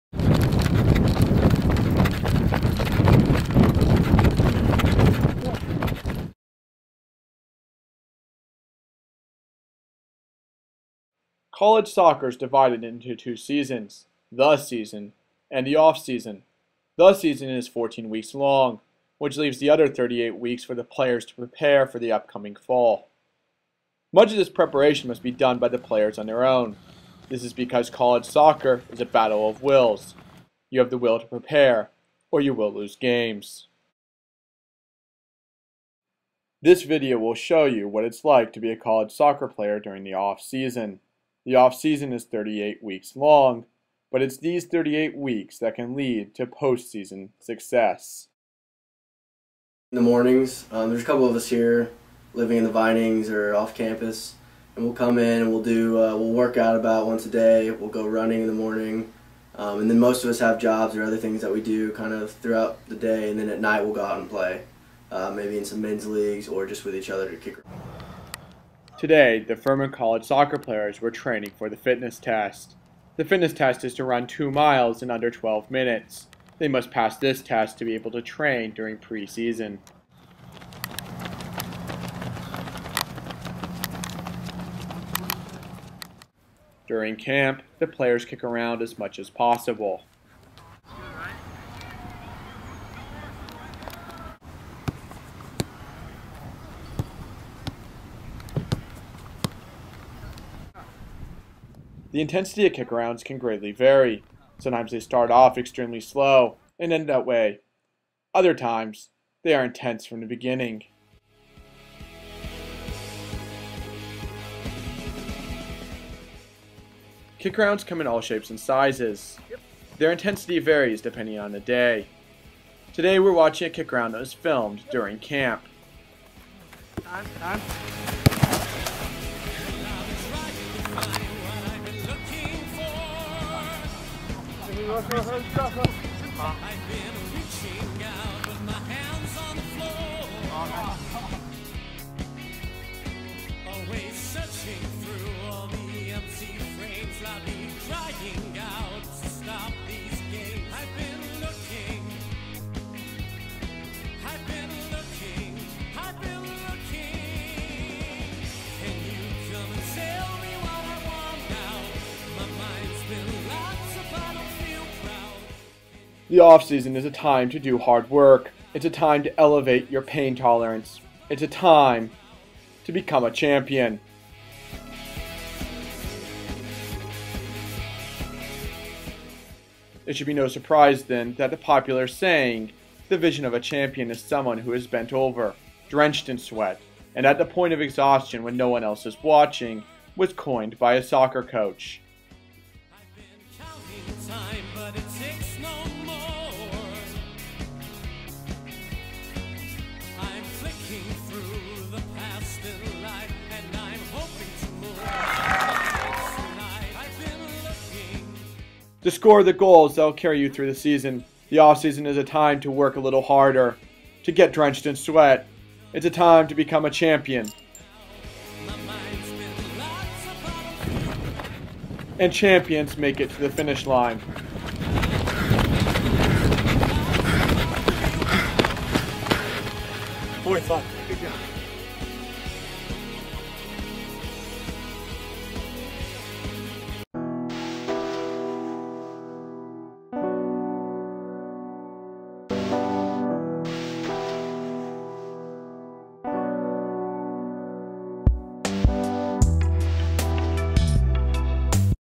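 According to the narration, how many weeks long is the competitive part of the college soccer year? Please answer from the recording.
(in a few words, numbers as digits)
14 weeks.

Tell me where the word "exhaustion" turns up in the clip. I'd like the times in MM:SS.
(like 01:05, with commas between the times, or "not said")
03:07.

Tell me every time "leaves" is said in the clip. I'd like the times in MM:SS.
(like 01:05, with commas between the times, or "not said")
00:19.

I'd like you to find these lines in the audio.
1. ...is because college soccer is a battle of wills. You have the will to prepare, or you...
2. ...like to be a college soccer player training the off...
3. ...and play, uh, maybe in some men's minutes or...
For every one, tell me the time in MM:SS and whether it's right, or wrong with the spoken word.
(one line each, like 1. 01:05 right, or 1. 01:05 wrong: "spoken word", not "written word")
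1. 00:27 right
2. 00:38 wrong: "during", not "training"
3. 01:04 wrong: "leagues", not "minutes".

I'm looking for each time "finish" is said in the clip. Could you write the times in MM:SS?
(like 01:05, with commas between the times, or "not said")
03:43.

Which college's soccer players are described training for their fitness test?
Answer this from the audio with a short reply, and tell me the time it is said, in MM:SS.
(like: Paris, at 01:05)
Furman, at 01:09.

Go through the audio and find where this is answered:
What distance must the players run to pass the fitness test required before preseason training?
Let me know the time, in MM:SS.
01:14.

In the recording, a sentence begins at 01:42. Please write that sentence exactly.
The intensity of kick-arounds can greatly vary.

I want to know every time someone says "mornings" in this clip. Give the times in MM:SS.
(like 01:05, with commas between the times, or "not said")
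00:50, 00:58.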